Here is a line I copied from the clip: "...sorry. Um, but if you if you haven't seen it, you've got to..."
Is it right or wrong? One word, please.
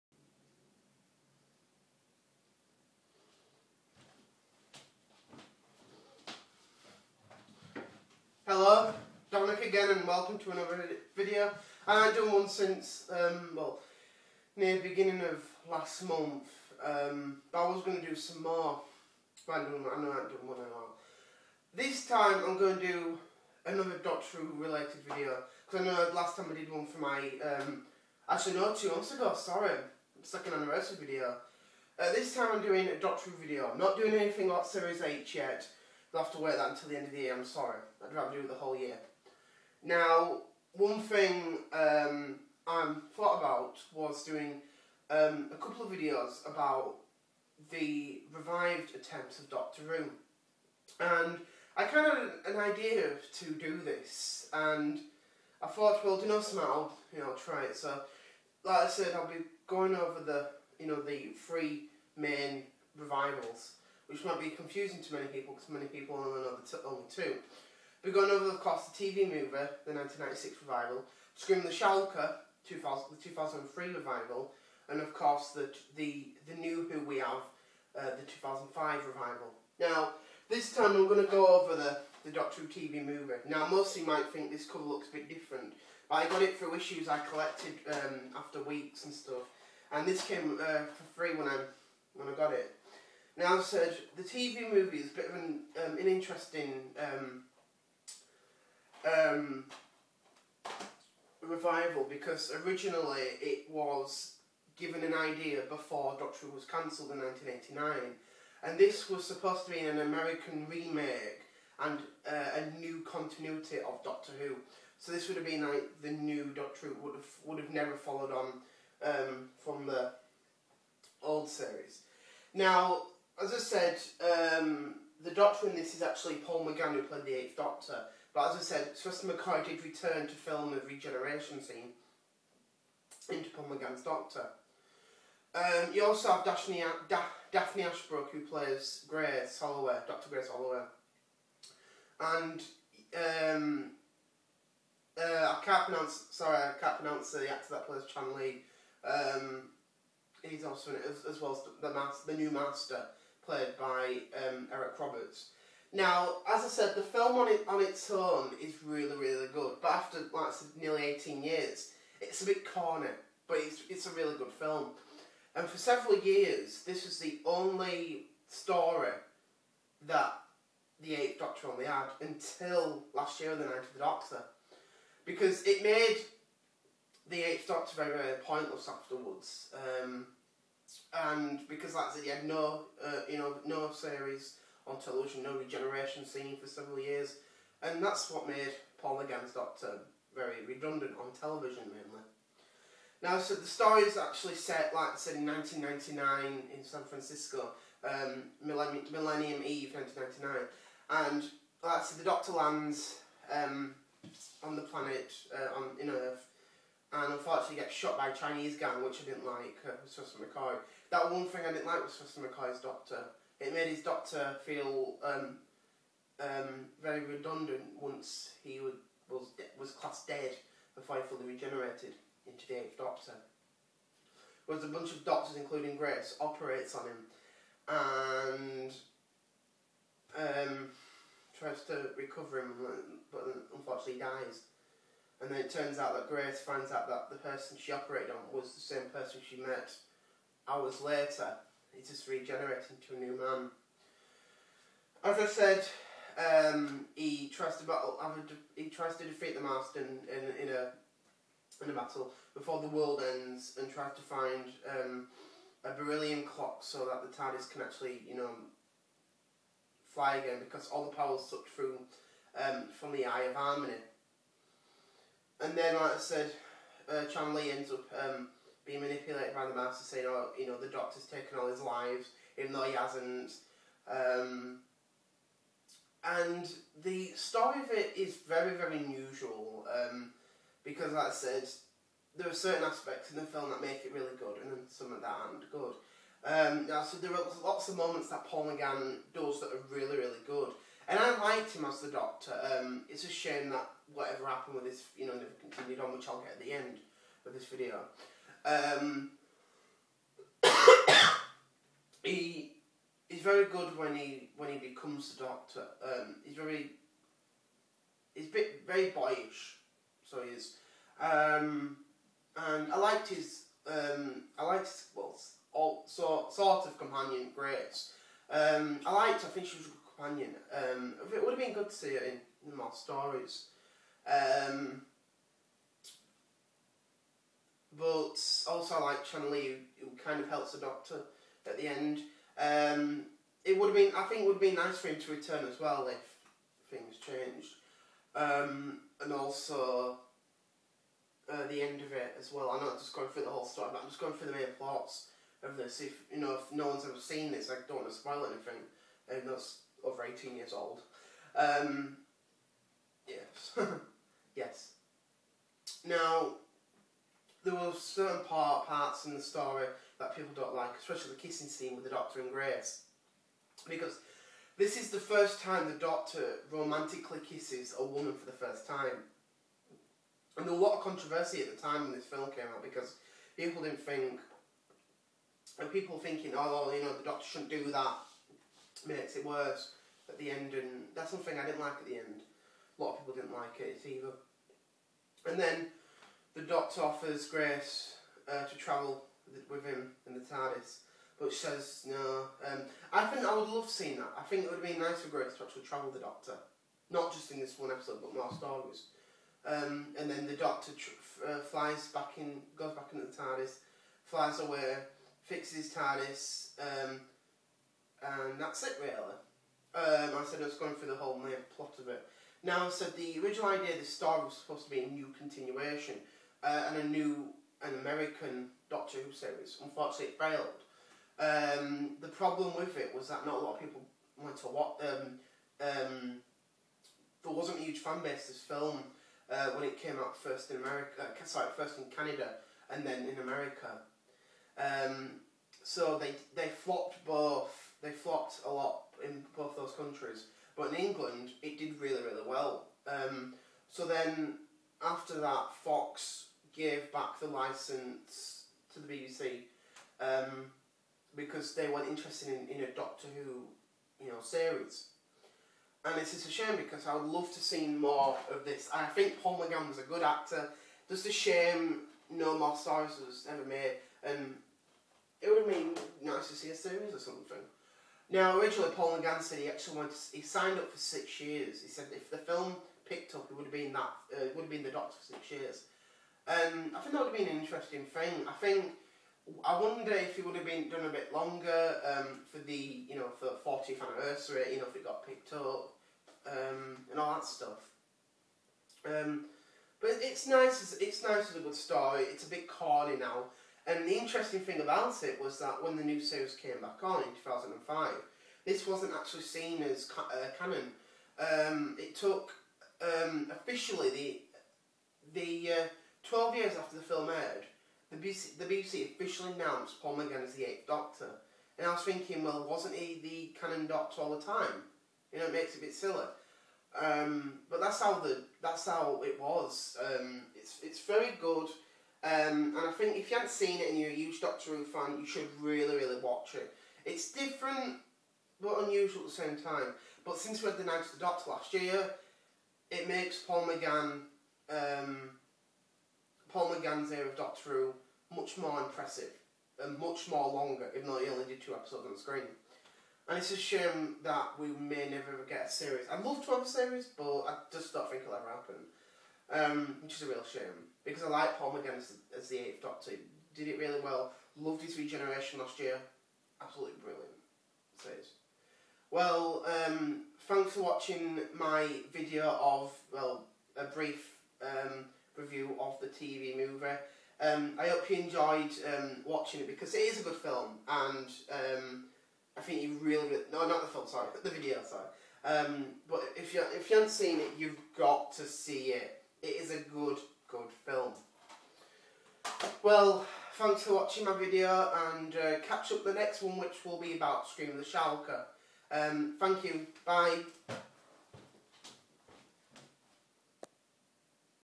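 right.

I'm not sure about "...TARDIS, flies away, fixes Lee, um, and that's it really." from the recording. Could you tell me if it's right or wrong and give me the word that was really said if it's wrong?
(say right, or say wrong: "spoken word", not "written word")
wrong: "TARDIS", not "Lee".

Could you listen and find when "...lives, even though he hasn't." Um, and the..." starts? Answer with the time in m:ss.
4:31.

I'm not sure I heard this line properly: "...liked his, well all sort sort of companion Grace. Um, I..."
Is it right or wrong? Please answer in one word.
right.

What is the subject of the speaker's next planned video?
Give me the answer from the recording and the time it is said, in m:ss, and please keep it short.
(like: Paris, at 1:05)
Scream of the Shalka, at 9:47.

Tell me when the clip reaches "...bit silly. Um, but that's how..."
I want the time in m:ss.
8:35.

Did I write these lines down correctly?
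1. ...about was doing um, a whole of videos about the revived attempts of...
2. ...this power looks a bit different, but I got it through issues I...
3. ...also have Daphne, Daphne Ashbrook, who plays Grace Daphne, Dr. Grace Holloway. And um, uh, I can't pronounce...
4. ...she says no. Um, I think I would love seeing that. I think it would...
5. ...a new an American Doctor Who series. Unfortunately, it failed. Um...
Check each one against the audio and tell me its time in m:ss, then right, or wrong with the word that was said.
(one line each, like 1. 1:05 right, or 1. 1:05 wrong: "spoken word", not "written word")
1. 0:43 wrong: "couple", not "whole"
2. 1:24 wrong: "cover", not "power"
3. 2:16 wrong: "Holloway", not "Daphne"
4. 6:31 right
5. 6:56 right.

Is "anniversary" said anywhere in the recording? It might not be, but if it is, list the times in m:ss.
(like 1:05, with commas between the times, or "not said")
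0:30, 8:04.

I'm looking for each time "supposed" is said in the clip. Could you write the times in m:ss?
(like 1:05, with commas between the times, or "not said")
1:49, 6:54.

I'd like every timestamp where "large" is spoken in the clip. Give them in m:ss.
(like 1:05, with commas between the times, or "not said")
not said.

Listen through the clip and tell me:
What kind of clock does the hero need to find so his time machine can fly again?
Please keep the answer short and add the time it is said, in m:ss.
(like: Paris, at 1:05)
a beryllium clock, at 4:15.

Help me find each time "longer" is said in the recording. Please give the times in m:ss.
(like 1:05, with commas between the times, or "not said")
8:01, 9:00.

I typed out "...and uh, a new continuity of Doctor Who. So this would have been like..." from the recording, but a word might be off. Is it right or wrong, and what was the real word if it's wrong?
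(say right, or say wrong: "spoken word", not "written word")
right.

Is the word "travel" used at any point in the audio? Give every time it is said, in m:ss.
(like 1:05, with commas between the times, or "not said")
6:28, 6:35.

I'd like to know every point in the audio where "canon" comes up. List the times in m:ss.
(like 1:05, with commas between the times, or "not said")
8:20, 8:33.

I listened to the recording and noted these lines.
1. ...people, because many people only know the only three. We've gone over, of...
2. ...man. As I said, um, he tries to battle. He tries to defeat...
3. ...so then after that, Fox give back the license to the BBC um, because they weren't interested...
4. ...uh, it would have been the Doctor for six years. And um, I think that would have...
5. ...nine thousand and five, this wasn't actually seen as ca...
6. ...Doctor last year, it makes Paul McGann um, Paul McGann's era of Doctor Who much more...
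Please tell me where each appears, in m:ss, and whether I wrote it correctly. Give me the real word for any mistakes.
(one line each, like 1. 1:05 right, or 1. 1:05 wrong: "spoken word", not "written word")
1. 1:05 wrong: "two", not "three"
2. 4:03 right
3. 7:23 right
4. 7:54 right
5. 8:17 wrong: "two", not "nine"
6. 8:51 right.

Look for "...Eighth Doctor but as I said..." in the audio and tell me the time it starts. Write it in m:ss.
2:07.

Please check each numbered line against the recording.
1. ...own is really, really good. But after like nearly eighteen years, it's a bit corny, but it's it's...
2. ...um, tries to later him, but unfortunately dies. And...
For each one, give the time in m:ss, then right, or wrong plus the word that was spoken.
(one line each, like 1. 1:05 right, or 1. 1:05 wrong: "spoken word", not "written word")
1. 2:38 right
2. 3:50 wrong: "recover", not "later".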